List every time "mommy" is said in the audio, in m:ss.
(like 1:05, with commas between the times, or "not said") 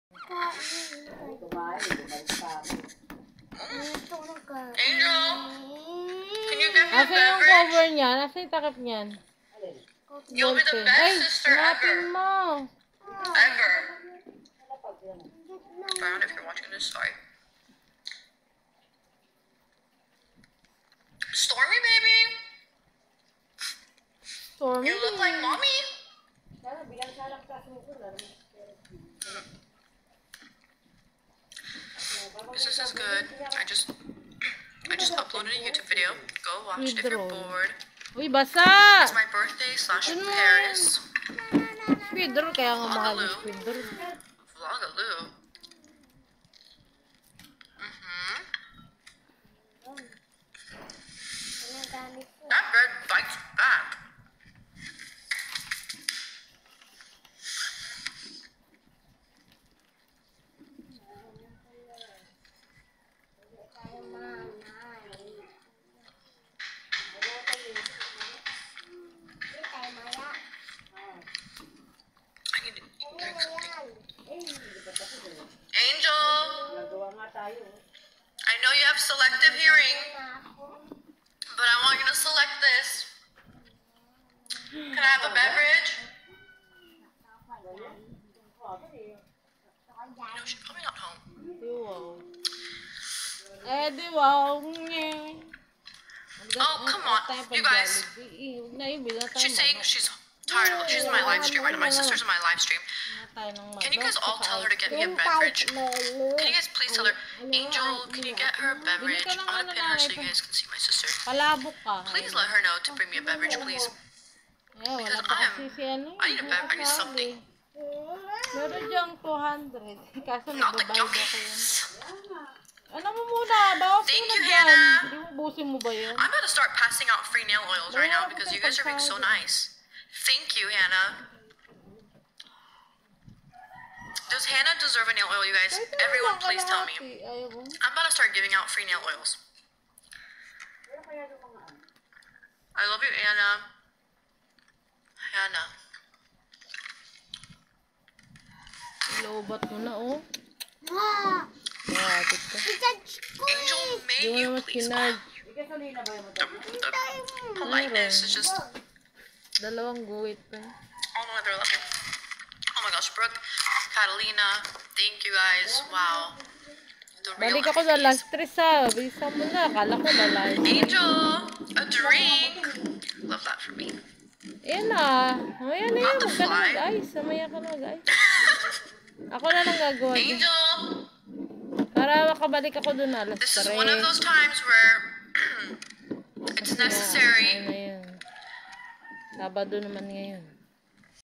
0:25.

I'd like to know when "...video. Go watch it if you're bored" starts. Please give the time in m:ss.
0:35.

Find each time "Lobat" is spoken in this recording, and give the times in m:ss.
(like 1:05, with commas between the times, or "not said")
2:29.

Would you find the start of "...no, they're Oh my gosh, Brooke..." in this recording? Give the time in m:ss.
2:39.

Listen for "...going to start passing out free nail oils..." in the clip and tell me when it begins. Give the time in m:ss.
2:06.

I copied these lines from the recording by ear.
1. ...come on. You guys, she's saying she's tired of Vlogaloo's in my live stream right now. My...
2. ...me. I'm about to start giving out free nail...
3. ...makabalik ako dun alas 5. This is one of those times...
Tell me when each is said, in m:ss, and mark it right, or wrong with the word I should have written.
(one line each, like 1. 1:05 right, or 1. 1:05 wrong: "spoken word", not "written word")
1. 1:36 wrong: "She", not "Vlogaloo"
2. 2:16 right
3. 3:02 wrong: "3", not "5".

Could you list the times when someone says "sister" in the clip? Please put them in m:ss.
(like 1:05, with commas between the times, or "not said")
0:11, 1:41, 1:50.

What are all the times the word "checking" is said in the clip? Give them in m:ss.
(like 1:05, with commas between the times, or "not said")
not said.